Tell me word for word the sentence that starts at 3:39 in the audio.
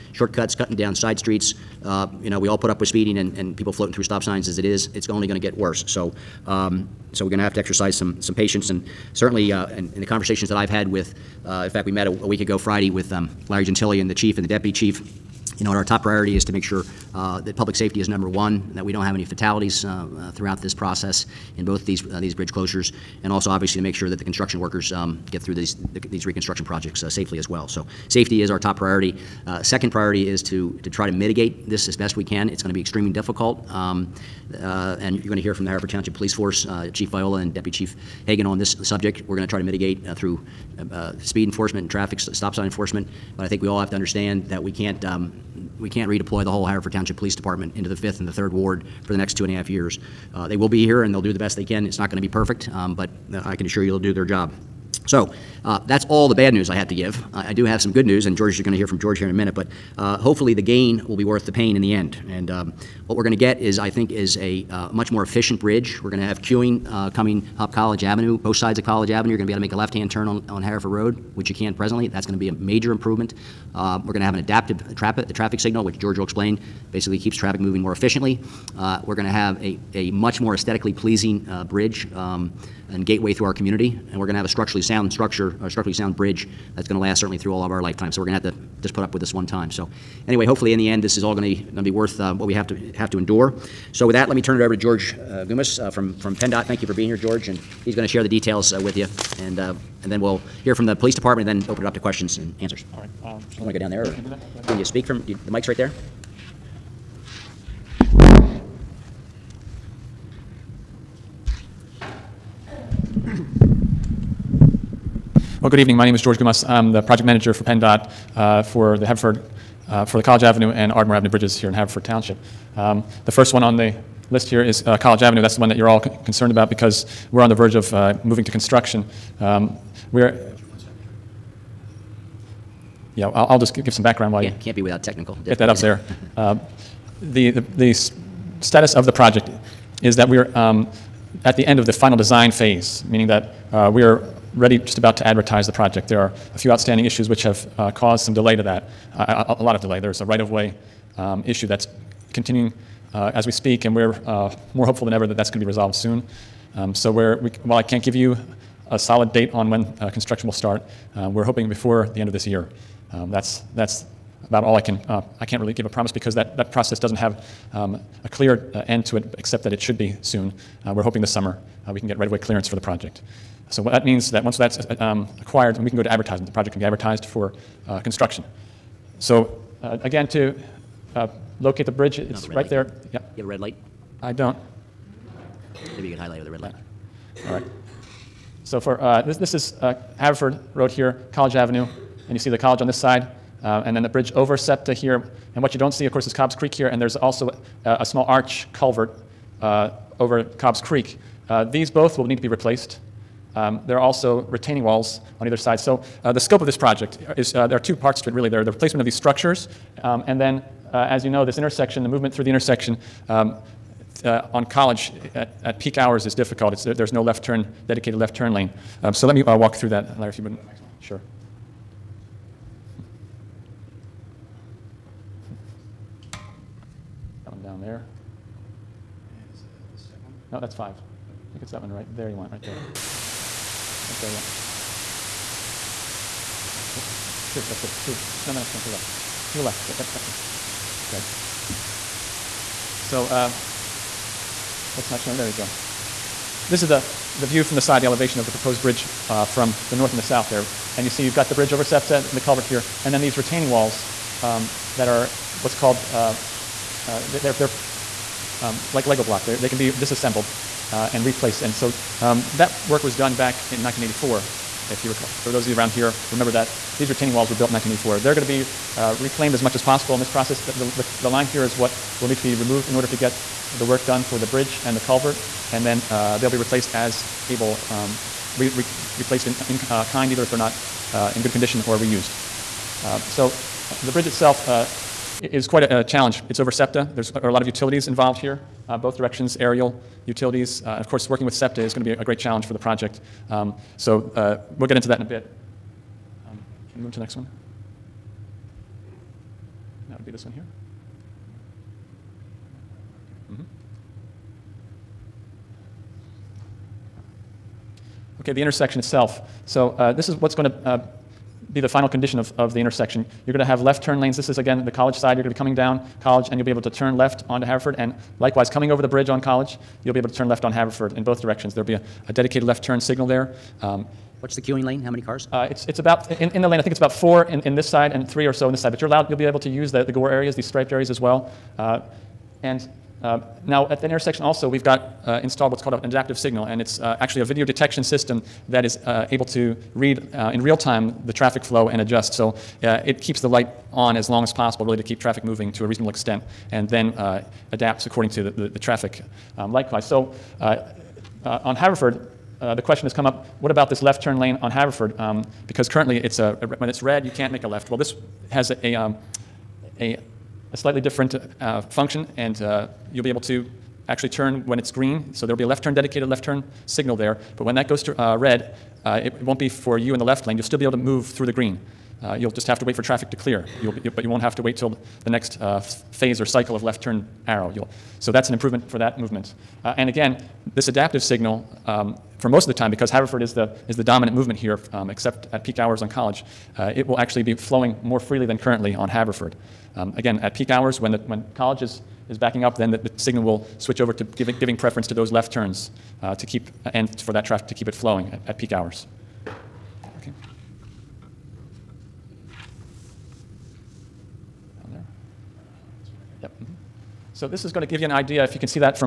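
Um, so let me uh, walk through that, Larry, if you wouldn't.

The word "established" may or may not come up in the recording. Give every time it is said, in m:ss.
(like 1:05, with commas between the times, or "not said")
not said.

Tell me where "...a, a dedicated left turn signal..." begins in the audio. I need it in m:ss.
5:21.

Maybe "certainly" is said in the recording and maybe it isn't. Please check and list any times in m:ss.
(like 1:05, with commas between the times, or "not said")
0:09, 1:27.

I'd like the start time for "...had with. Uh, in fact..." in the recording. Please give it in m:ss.
0:10.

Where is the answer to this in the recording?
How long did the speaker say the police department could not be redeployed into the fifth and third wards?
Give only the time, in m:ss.
0:49.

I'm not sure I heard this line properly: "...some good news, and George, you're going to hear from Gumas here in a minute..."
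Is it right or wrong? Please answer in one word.
wrong.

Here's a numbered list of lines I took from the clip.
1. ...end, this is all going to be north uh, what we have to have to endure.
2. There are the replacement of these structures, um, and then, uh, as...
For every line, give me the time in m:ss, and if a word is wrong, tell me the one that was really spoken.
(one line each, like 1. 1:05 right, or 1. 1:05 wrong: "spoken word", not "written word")
1. 1:30 wrong: "worth", not "north"
2. 3:28 right.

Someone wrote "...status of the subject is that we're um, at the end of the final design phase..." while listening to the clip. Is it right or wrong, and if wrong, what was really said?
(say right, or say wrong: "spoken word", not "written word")
wrong: "project", not "subject".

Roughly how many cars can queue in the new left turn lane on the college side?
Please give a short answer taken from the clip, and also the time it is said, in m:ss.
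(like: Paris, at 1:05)
4, at 5:27.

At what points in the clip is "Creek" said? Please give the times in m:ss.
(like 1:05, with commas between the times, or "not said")
3:16, 3:20.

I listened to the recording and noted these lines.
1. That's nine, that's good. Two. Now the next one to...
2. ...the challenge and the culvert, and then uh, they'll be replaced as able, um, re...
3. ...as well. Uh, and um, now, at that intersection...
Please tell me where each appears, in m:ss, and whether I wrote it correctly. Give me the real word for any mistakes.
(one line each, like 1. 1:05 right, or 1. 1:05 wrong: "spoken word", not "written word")
1. 3:56 wrong: "two", not "nine"
2. 4:34 wrong: "bridge", not "challenge"
3. 5:31 right.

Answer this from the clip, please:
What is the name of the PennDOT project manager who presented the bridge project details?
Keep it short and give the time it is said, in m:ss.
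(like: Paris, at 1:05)
George Gumas, at 1:56.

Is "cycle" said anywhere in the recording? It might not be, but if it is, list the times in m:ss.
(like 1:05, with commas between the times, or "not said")
6:16.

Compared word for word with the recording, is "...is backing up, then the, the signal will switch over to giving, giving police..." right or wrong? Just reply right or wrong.
wrong.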